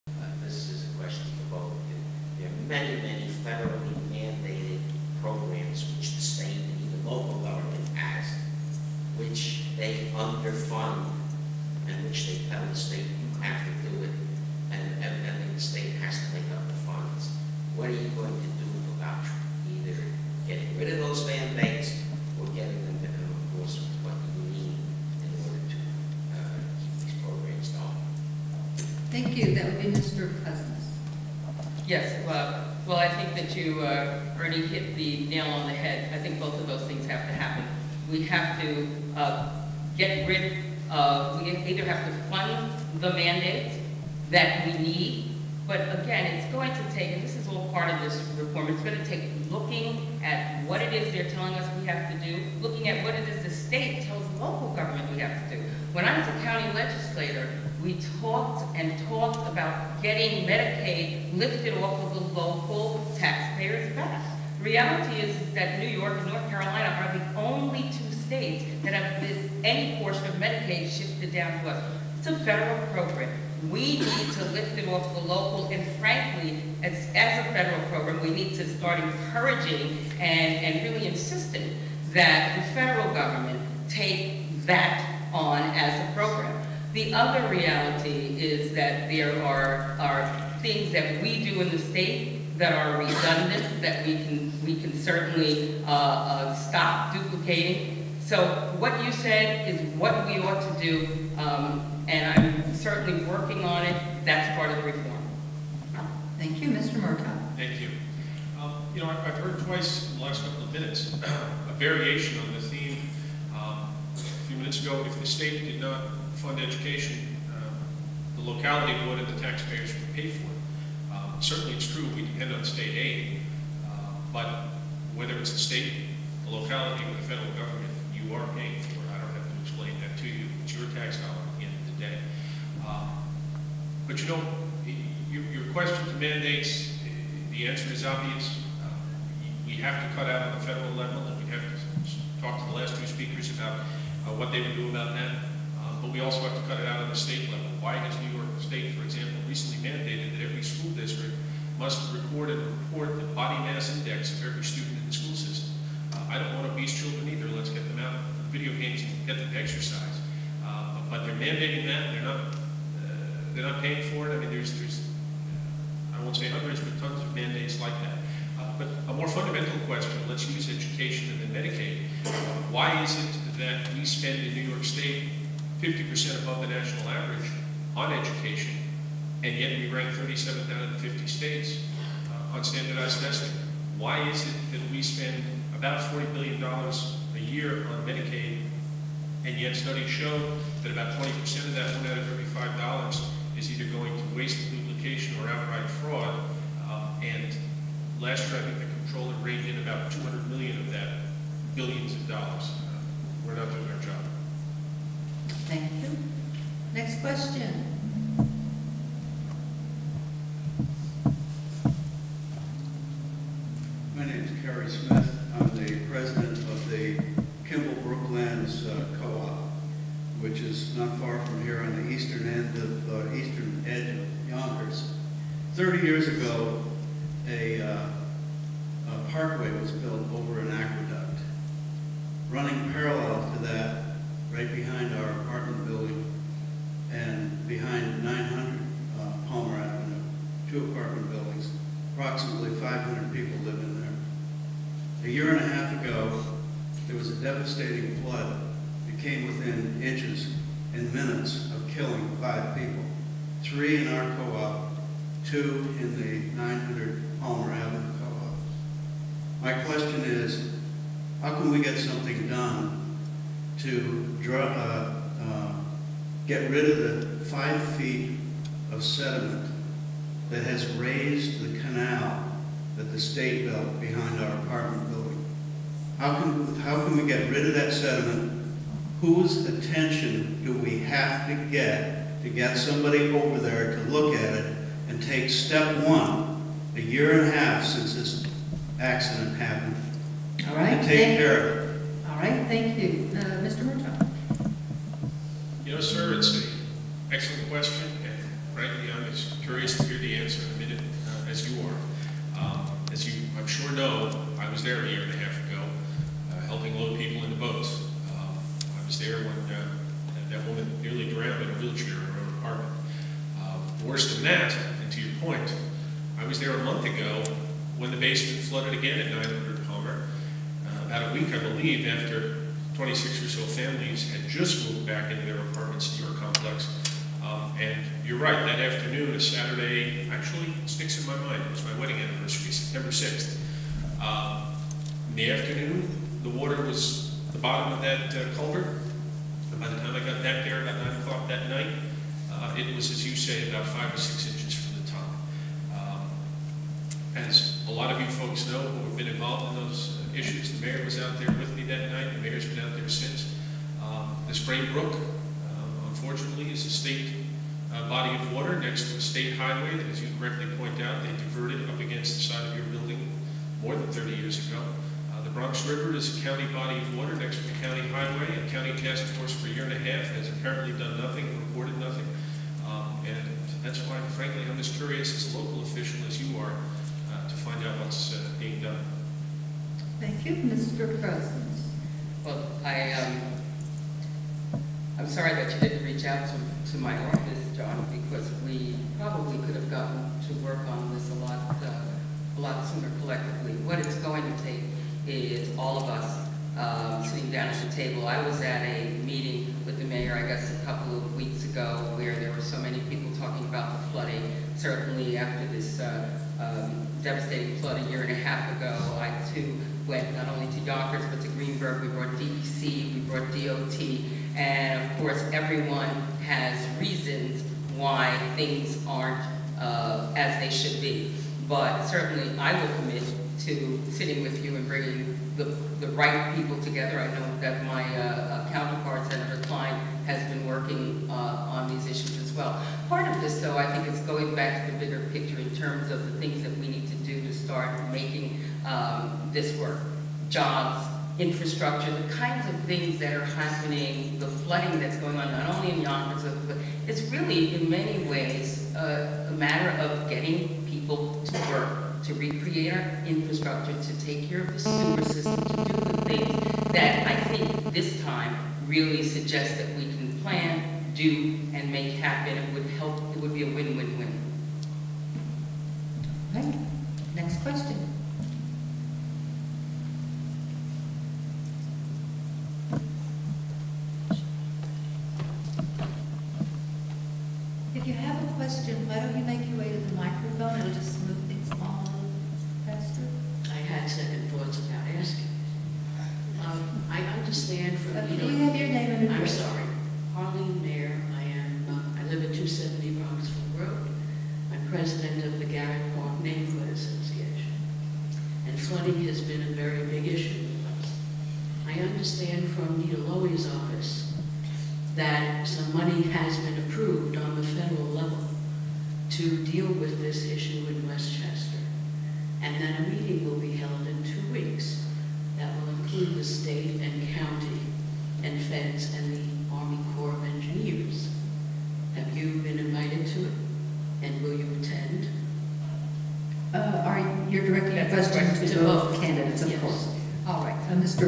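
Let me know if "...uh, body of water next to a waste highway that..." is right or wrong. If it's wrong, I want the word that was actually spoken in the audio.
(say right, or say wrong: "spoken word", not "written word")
wrong: "state", not "waste".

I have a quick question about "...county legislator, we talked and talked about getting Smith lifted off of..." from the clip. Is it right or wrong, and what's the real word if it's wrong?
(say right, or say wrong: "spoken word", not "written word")
wrong: "Medicaid", not "Smith".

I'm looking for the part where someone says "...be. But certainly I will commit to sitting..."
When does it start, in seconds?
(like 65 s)
421 s.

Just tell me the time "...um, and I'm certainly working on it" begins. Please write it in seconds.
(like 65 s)
101 s.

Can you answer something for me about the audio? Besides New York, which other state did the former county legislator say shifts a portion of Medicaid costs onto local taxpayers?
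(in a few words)
North Carolina.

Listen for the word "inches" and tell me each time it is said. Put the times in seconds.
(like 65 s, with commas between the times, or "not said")
250 s, 344 s.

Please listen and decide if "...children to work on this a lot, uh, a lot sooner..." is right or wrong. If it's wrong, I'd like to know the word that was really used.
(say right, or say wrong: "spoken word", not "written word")
wrong: "gotten", not "children".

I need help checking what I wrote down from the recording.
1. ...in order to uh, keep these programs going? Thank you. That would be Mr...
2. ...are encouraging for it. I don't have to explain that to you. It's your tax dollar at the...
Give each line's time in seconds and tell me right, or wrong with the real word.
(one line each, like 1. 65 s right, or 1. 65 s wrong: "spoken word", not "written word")
1. 25 s right
2. 128 s wrong: "paying", not "encouraging".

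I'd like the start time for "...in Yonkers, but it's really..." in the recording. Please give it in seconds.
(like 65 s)
445 s.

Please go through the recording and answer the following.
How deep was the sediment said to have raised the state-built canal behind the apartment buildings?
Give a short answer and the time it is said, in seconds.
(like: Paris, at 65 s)
5 feet, at 267 s.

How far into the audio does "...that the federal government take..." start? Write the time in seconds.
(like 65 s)
82 s.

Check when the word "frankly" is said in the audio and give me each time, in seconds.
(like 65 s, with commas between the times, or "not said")
75 s, 298 s, 374 s.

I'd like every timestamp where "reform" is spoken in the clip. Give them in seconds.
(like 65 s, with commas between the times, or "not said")
48 s, 104 s.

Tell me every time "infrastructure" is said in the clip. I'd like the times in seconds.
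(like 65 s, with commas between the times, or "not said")
441 s, 453 s.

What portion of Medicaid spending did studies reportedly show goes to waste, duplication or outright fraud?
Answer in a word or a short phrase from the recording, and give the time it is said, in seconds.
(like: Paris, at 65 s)
20%, at 191 s.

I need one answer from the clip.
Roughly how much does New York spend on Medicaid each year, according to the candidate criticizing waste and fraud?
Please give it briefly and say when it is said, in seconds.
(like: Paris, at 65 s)
$40 billion, at 186 s.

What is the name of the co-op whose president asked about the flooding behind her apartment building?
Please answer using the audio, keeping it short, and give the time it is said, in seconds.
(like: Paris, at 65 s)
Kimball Brooklands, at 217 s.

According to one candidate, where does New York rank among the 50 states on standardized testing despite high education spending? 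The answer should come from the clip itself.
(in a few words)
37th.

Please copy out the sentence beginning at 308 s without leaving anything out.
Um, I was there when uh, that woman nearly drowned in a wheelchair in her own apartment.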